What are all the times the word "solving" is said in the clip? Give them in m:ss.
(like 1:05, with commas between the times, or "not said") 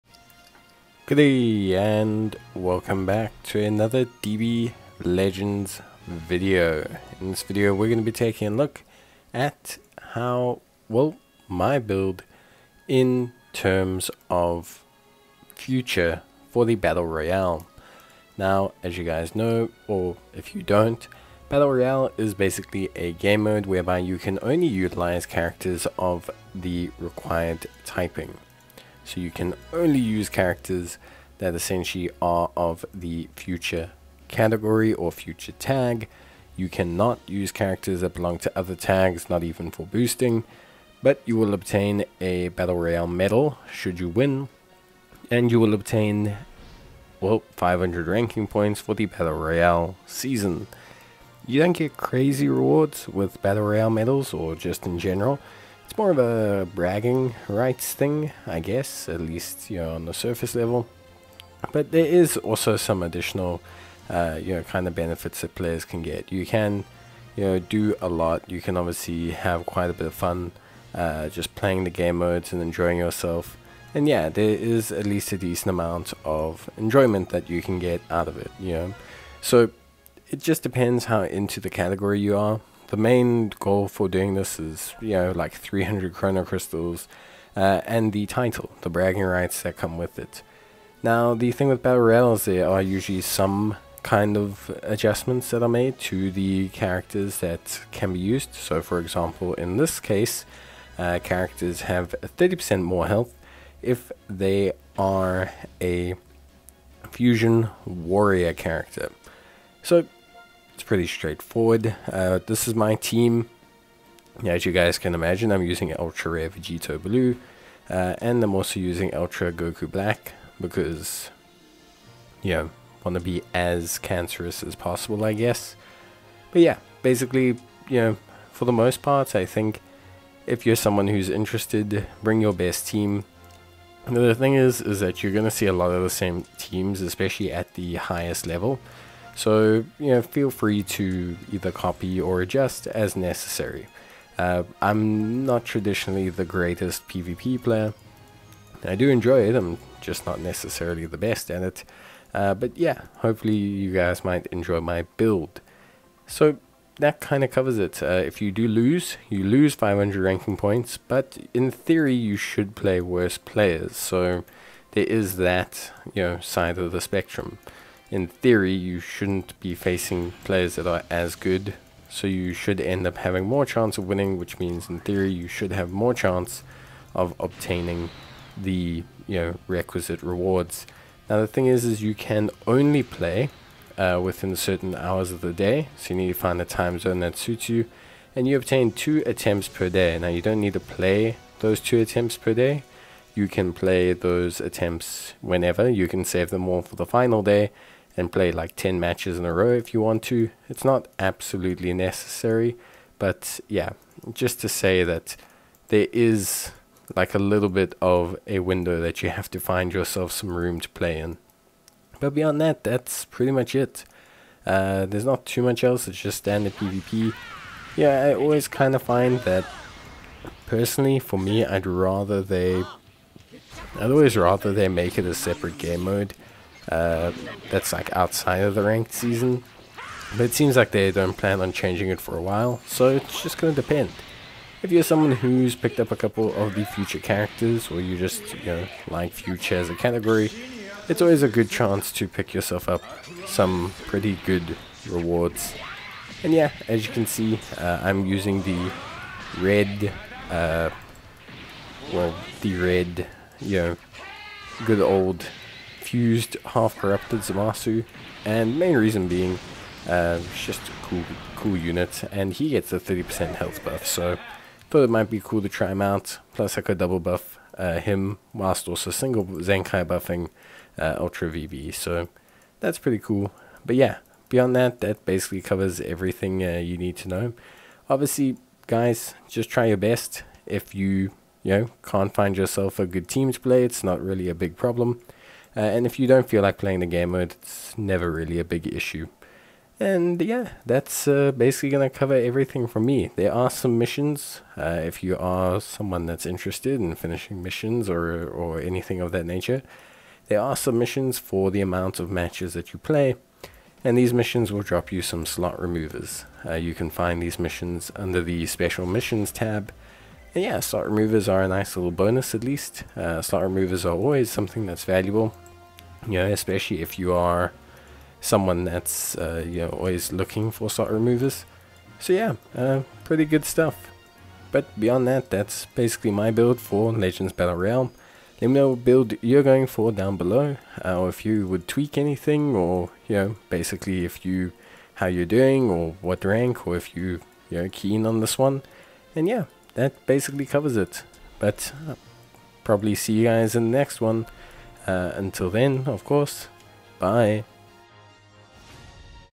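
not said.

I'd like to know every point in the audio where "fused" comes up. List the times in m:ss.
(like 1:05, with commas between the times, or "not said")
4:16.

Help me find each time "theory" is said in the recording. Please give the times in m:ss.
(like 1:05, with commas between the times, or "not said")
2:41, 2:48, 2:54.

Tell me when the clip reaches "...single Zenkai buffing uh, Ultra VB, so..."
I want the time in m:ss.
4:29.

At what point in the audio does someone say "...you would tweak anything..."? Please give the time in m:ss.
5:31.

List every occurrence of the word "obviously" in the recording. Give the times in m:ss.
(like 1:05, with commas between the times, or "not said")
1:08, 4:38.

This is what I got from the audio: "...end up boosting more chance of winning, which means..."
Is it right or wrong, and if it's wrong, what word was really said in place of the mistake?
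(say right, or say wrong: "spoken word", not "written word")
wrong: "having", not "boosting".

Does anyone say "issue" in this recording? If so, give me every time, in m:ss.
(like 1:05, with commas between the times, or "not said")
4:48.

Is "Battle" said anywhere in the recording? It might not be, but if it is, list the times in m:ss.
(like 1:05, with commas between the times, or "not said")
0:16, 0:21, 0:42, 0:49, 0:53, 1:31, 5:27.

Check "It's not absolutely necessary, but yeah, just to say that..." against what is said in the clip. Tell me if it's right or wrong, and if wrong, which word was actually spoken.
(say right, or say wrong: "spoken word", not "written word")
right.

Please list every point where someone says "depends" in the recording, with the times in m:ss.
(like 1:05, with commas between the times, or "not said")
1:20, 3:53.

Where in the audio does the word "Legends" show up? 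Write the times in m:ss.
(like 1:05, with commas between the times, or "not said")
0:05, 5:27.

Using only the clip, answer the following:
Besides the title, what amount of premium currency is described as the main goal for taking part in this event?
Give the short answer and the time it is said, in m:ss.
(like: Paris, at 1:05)
300 chrono crystals, at 1:25.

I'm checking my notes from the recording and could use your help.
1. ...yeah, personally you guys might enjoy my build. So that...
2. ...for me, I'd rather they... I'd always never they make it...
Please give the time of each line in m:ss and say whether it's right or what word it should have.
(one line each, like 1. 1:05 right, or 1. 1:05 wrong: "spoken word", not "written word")
1. 2:32 wrong: "hopefully", not "personally"
2. 3:41 wrong: "rather", not "never".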